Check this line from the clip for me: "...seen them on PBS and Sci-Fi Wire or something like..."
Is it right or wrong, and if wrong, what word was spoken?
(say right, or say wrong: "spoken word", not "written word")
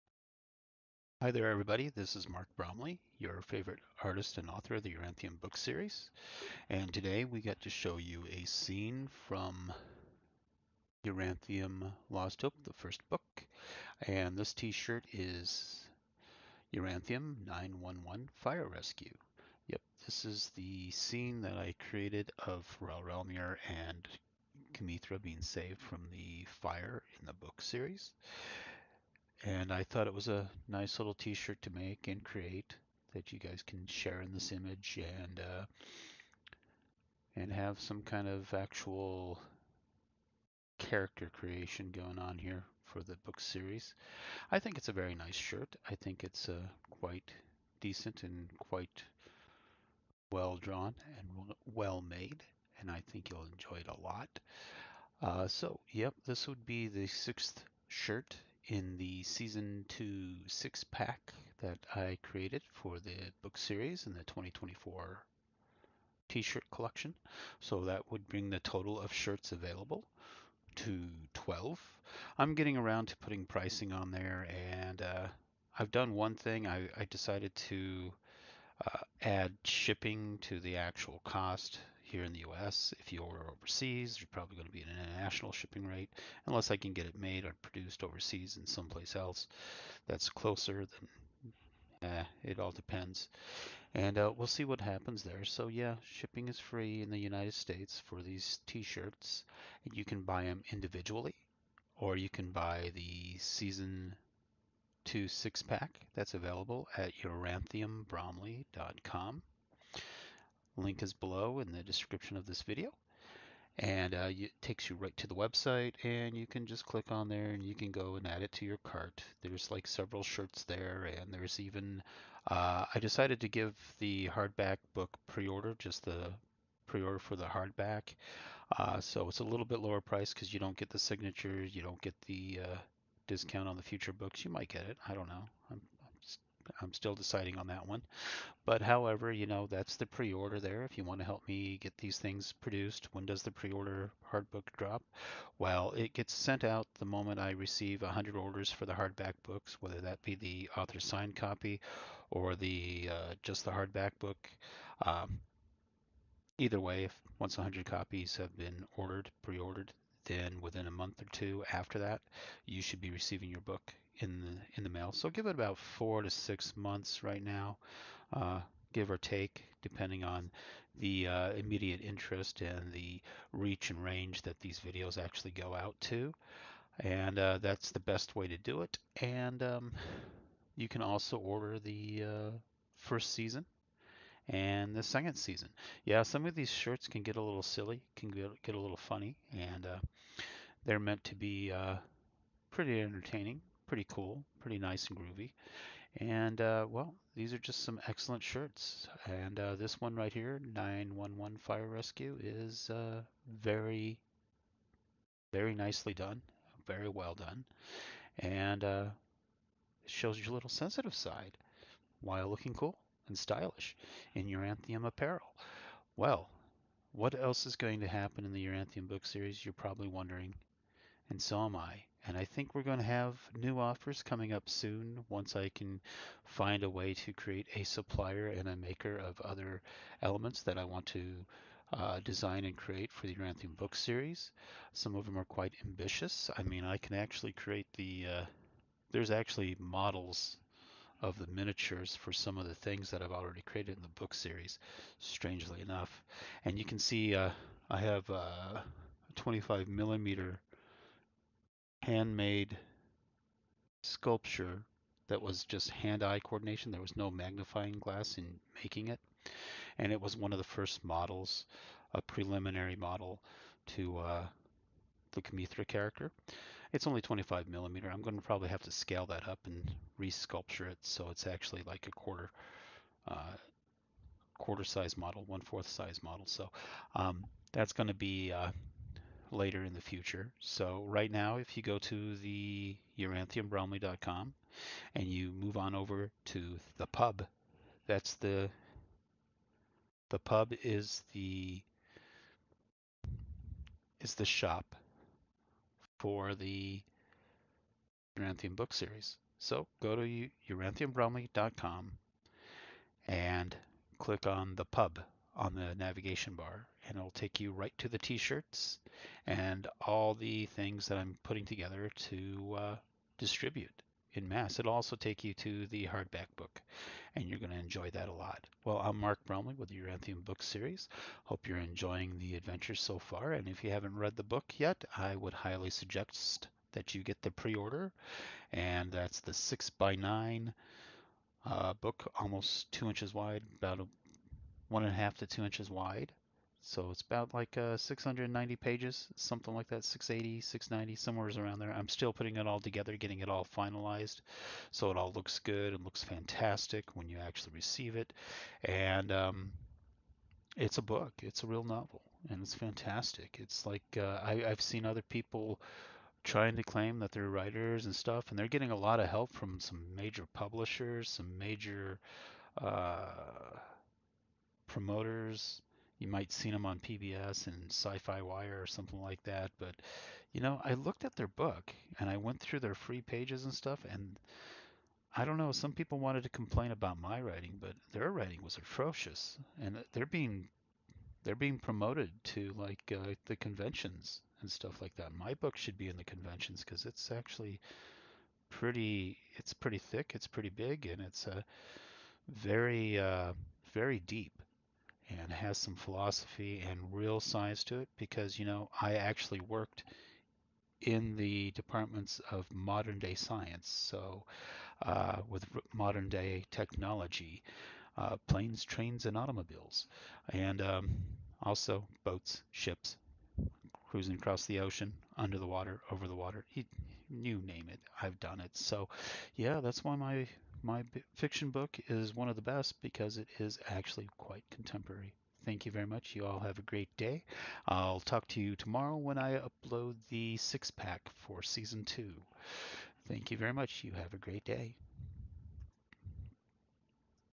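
right.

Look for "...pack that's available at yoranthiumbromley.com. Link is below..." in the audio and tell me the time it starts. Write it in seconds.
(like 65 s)
105 s.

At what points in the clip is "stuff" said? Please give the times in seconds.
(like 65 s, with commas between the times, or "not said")
358 s, 373 s, 384 s.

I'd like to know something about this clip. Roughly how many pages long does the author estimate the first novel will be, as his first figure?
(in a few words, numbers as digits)
690.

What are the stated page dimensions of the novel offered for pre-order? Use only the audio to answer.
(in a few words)
6 by 9.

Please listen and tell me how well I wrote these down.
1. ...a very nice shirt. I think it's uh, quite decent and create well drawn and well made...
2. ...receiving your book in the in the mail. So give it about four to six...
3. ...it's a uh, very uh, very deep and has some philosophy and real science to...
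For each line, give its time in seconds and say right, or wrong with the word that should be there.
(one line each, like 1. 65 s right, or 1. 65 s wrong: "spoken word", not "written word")
1. 44 s wrong: "quite", not "create"
2. 163 s right
3. 391 s right.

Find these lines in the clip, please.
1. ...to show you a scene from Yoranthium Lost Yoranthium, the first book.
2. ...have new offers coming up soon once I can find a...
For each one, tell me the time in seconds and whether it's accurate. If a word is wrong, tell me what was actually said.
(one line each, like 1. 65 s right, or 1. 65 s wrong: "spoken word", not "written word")
1. 7 s wrong: "Hope", not "Yoranthium"
2. 223 s right.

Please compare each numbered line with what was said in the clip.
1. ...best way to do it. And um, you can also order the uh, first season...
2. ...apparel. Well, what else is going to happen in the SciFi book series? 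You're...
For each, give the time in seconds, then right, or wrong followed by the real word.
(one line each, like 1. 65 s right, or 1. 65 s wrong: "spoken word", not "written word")
1. 177 s right
2. 215 s wrong: "Yoranthium", not "SciFi".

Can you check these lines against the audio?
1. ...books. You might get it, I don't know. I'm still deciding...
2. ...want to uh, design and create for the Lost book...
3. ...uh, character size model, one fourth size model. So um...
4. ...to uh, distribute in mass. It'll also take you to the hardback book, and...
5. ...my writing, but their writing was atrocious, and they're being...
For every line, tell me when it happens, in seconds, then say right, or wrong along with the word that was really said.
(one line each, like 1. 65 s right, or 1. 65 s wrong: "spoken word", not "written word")
1. 134 s right
2. 230 s wrong: "Yoranthium", not "Lost"
3. 273 s wrong: "quarter", not "character"
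4. 312 s right
5. 377 s right.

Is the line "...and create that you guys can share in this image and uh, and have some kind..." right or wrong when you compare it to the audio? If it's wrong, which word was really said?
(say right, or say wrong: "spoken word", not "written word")
right.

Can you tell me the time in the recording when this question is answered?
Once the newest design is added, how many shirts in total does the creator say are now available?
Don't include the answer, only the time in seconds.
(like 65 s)
71 s.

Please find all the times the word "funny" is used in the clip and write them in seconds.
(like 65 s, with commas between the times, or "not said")
188 s.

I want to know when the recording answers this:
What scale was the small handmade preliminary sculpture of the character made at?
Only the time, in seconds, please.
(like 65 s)
249 s.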